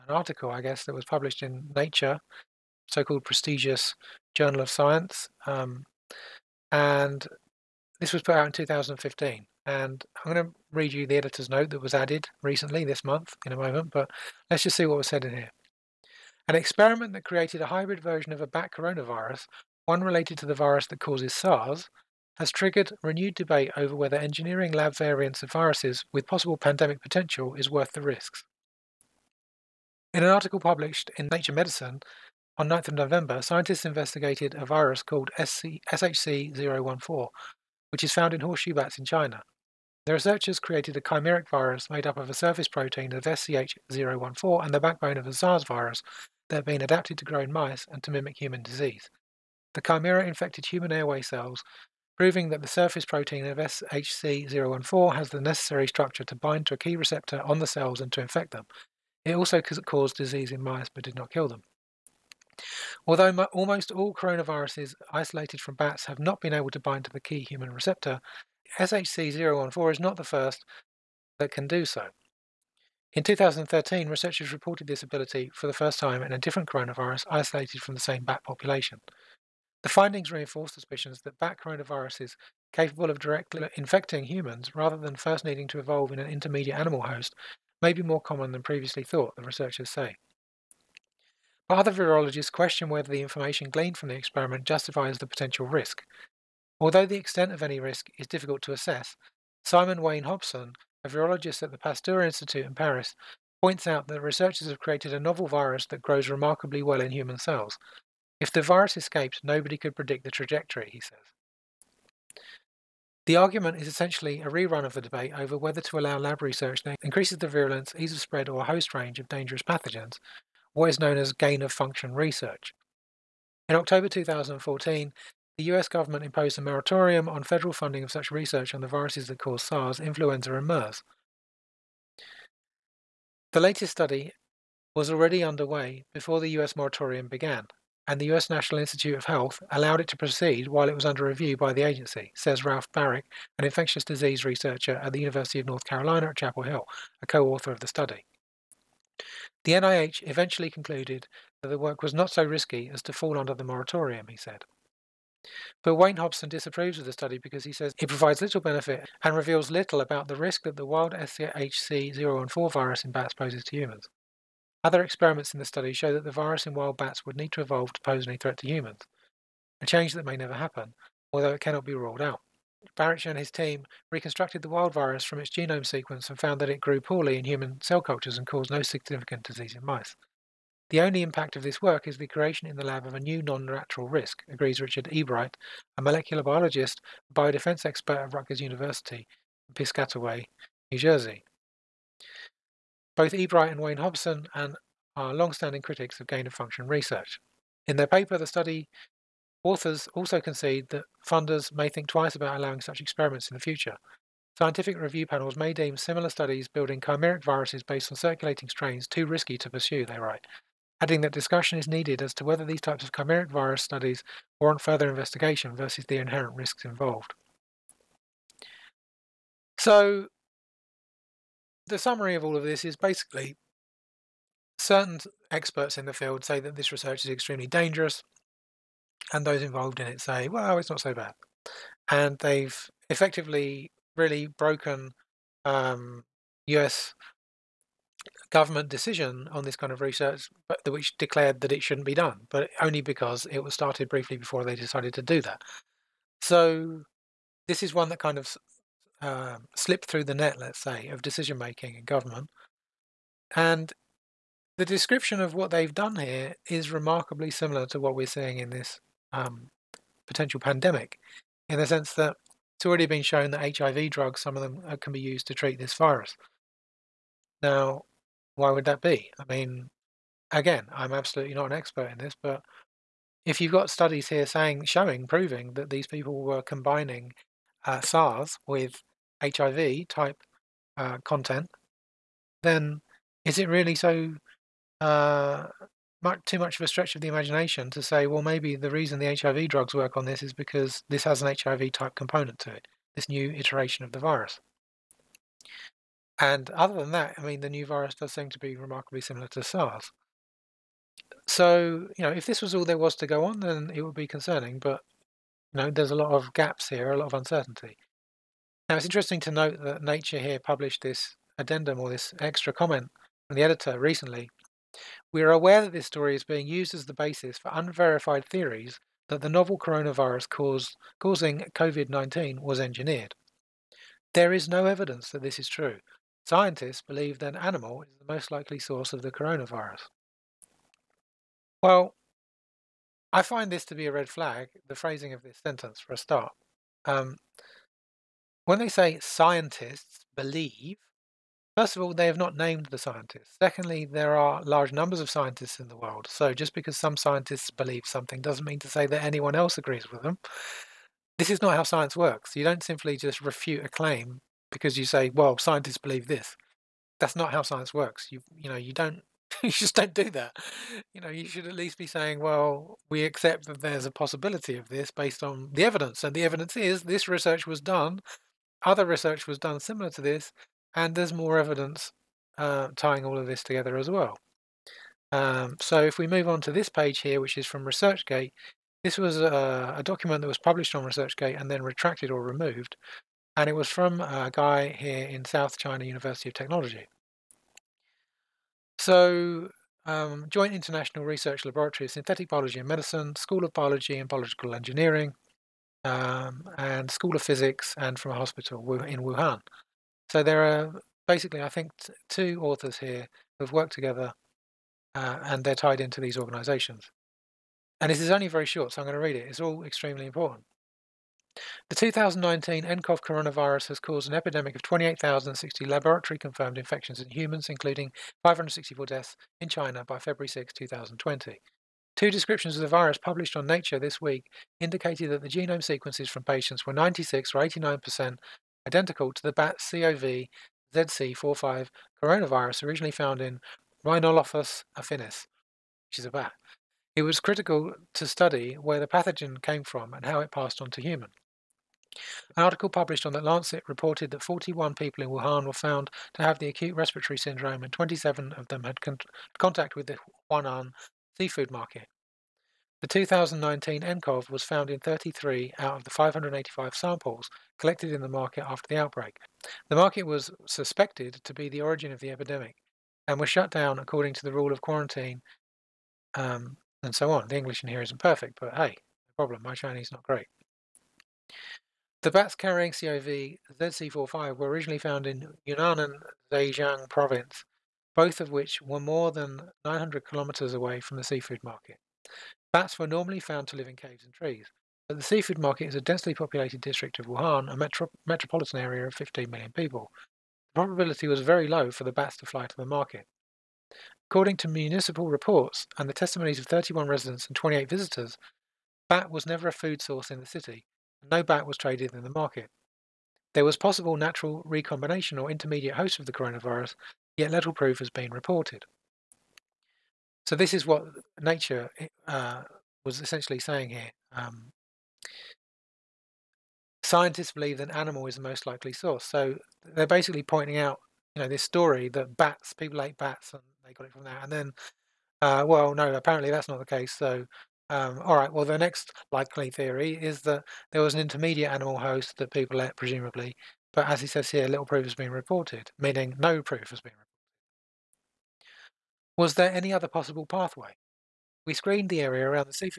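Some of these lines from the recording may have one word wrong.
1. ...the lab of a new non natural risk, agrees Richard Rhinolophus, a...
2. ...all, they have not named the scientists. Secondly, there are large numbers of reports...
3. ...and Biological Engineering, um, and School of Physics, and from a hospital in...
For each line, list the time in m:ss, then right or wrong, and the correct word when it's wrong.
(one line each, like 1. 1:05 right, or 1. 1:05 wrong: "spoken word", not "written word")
1. 3:02 wrong: "Ebright", not "Rhinolophus"
2. 5:42 wrong: "scientists", not "reports"
3. 6:34 right.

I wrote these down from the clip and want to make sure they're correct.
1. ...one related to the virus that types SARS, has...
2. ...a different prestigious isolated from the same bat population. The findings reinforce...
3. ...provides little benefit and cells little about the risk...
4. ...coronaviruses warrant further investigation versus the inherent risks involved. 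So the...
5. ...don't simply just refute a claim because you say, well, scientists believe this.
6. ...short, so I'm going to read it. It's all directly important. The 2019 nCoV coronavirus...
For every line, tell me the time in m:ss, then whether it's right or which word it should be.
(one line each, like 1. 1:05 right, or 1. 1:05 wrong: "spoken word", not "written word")
1. 0:19 wrong: "causes", not "types"
2. 1:16 wrong: "coronavirus", not "prestigious"
3. 2:38 wrong: "reveals", not "cells"
4. 3:33 wrong: "studies", not "coronaviruses"
5. 5:52 right
6. 6:48 wrong: "extremely", not "directly".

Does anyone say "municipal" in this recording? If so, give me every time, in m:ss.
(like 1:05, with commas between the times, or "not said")
8:14.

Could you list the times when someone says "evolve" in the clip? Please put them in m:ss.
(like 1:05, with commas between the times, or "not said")
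1:25, 2:47.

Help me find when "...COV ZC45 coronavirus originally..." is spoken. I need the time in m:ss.
7:09.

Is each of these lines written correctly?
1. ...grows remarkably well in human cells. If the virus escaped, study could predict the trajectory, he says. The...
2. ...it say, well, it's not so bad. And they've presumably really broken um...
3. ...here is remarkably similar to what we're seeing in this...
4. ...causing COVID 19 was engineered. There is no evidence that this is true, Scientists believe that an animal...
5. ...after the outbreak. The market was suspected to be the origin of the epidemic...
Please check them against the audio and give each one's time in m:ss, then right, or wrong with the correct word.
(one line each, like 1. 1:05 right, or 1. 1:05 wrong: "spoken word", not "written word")
1. 1:46 wrong: "nobody", not "study"
2. 3:50 wrong: "effectively", not "presumably"
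3. 4:16 right
4. 5:21 right
5. 7:38 right.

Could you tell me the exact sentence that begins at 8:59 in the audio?
Was there any other possible pathway?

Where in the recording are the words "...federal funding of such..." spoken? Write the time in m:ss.
2:07.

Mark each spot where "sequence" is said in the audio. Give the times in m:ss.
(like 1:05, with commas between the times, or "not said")
2:55, 7:05.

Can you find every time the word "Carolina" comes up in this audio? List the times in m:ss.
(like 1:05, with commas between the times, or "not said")
2:25.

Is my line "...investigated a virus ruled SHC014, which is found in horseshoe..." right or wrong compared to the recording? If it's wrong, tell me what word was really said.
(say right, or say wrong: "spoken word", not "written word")
wrong: "called", not "ruled".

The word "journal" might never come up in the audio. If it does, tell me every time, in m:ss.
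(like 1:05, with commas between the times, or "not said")
0:04.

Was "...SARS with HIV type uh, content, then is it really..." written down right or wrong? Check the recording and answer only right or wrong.
right.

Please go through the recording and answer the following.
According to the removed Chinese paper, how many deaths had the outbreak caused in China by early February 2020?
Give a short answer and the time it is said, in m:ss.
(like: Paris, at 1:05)
564, at 6:58.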